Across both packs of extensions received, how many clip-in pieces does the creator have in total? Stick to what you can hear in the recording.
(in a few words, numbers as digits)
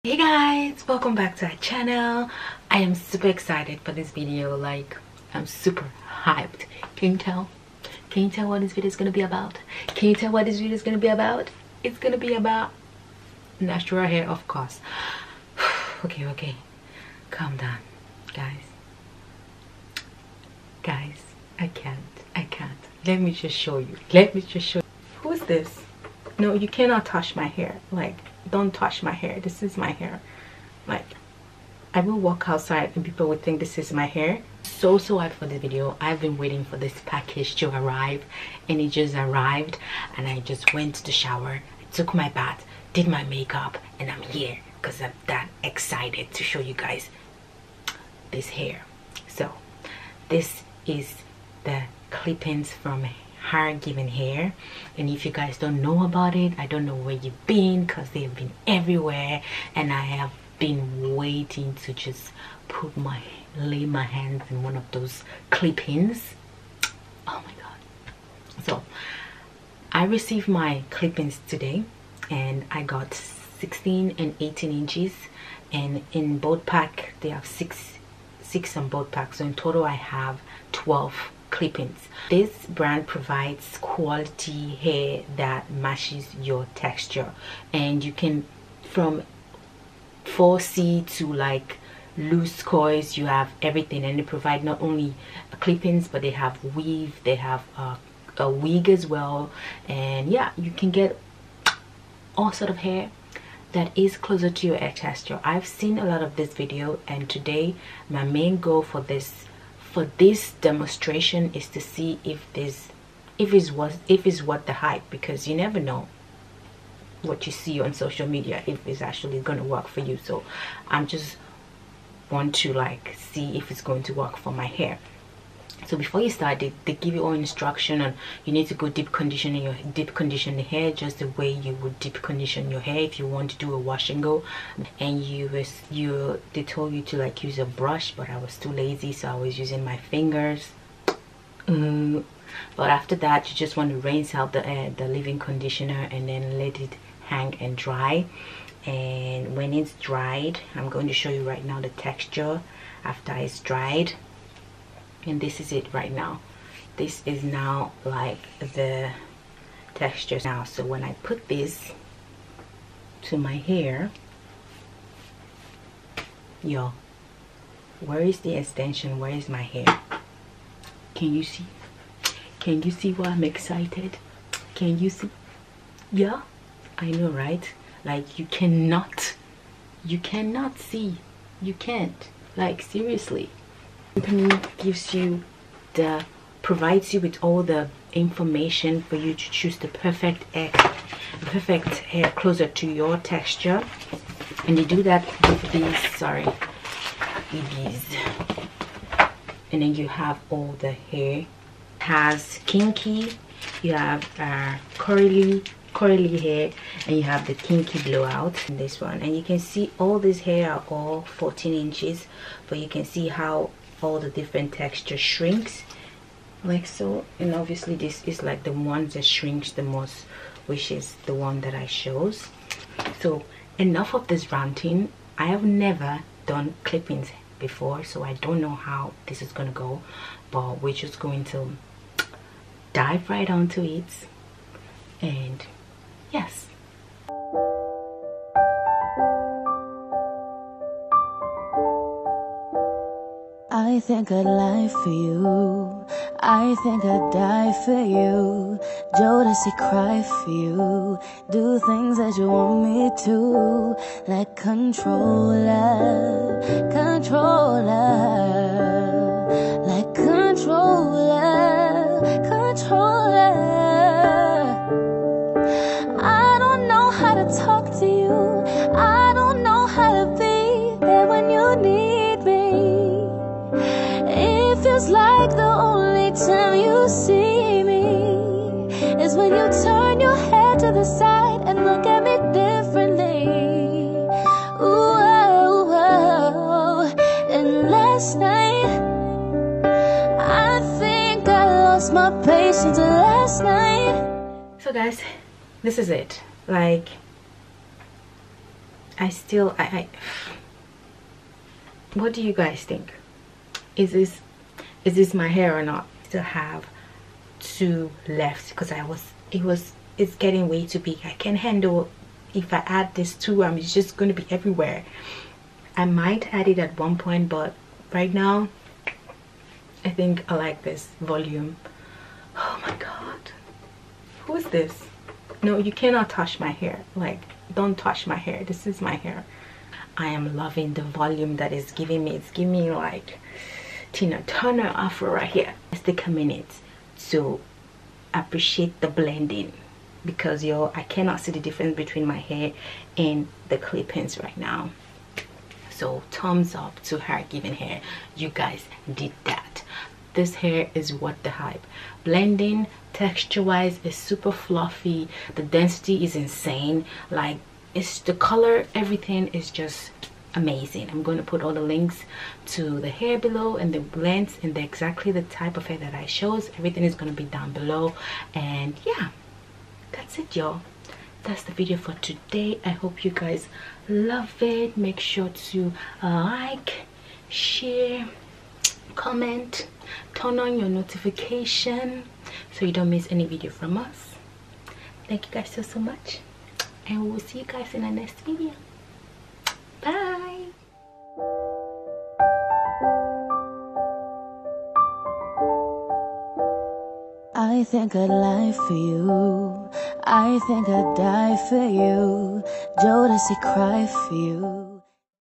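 12.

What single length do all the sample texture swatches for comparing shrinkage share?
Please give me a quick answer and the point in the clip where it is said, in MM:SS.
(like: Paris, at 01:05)
14 inches, at 03:31.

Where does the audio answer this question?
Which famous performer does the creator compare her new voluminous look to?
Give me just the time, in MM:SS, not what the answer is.
05:34.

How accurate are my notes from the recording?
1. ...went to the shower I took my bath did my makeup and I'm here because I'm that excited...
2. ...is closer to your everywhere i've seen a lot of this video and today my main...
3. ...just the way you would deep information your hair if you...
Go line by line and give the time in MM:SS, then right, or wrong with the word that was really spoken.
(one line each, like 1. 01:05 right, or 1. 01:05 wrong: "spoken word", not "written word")
1. 00:40 right
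2. 01:43 wrong: "texture", not "everywhere"
3. 02:10 wrong: "condition", not "information".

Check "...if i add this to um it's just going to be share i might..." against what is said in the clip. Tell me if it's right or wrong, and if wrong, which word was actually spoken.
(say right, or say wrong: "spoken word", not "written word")
wrong: "everywhere", not "share".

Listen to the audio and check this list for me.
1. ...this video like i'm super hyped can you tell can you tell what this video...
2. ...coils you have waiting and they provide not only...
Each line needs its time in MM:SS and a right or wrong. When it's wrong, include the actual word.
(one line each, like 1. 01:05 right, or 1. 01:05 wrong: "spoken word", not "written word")
1. 00:03 right
2. 01:32 wrong: "everything", not "waiting".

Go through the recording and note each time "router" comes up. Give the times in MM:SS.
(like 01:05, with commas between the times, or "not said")
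not said.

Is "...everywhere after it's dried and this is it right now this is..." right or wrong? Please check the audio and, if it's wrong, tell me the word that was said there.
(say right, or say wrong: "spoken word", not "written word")
wrong: "texture", not "everywhere".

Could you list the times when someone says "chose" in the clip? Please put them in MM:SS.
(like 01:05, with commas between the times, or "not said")
03:41, 06:06.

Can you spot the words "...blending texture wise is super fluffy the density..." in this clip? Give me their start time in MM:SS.
05:52.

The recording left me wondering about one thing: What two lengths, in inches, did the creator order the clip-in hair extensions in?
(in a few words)
16 and 18 inches.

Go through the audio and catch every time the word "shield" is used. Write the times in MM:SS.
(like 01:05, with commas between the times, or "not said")
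not said.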